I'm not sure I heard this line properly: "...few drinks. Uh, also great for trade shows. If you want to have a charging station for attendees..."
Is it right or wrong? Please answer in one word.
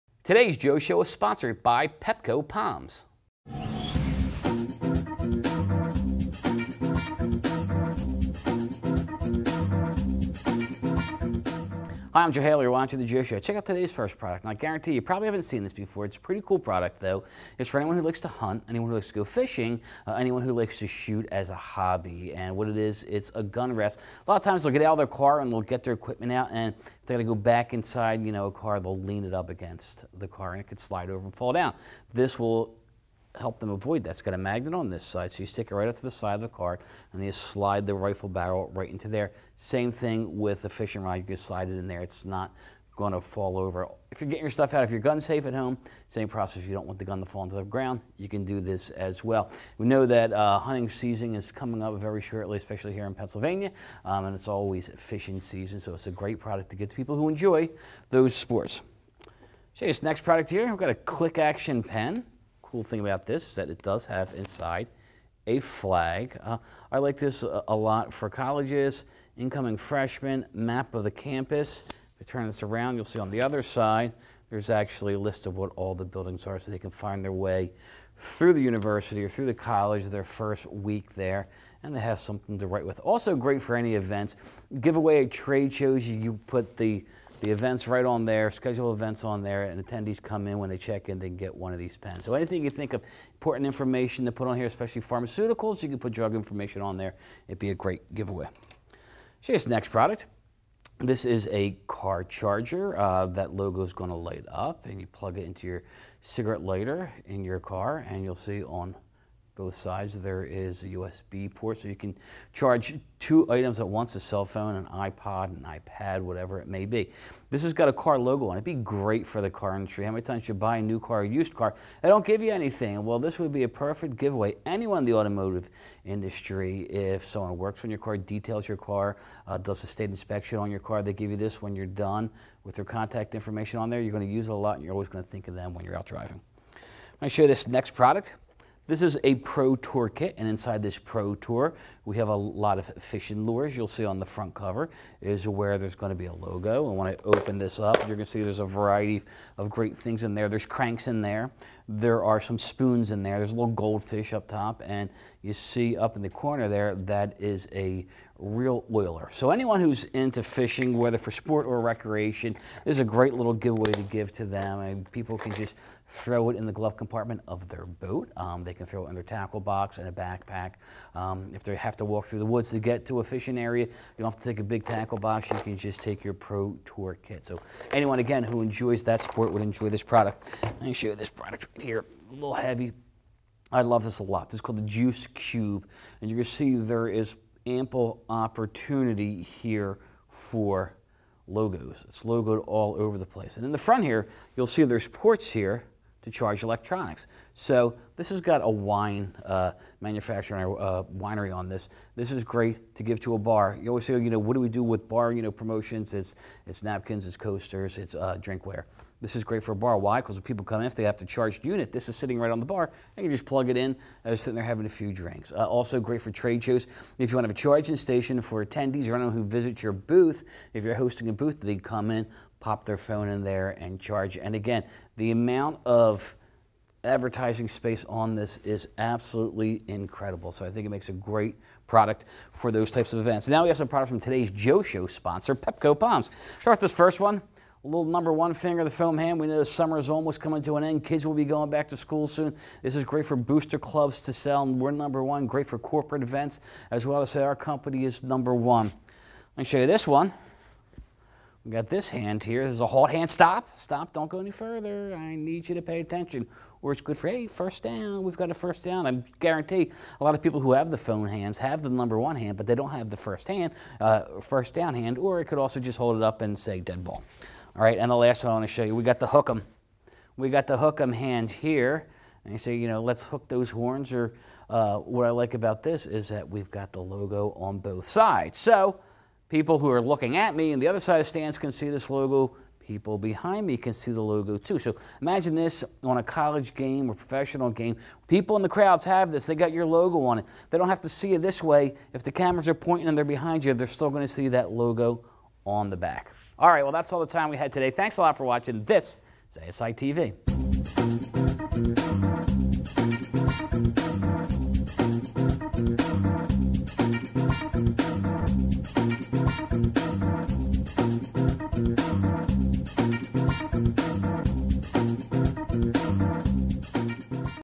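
right.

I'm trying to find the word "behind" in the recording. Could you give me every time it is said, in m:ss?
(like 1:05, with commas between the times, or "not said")
4:43, 4:53.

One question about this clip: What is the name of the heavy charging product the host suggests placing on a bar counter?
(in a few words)
Juice Cube.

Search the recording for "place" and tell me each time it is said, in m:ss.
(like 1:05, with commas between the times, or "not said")
3:13.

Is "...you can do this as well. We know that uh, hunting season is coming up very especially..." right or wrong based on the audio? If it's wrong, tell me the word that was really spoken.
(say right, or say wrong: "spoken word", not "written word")
wrong: "shortly", not "especially".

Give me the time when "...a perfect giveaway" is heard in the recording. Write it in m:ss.
2:03.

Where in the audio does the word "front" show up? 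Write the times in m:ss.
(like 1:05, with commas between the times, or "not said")
2:24, 3:13.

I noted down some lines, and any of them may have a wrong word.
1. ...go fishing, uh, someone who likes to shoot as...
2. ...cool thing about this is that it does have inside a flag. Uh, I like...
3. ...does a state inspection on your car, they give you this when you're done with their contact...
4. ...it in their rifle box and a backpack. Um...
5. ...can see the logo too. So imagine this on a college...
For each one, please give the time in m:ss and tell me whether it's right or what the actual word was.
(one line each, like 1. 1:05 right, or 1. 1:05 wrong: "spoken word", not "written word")
1. 0:19 wrong: "anyone", not "someone"
2. 1:02 right
3. 2:09 right
4. 2:49 wrong: "tackle", not "rifle"
5. 4:43 right.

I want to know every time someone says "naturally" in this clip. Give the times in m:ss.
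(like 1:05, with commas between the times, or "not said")
not said.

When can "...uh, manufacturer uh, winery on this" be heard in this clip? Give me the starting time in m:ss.
3:19.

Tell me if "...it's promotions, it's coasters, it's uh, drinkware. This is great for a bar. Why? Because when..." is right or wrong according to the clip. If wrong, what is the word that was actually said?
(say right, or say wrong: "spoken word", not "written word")
wrong: "napkins", not "promotions".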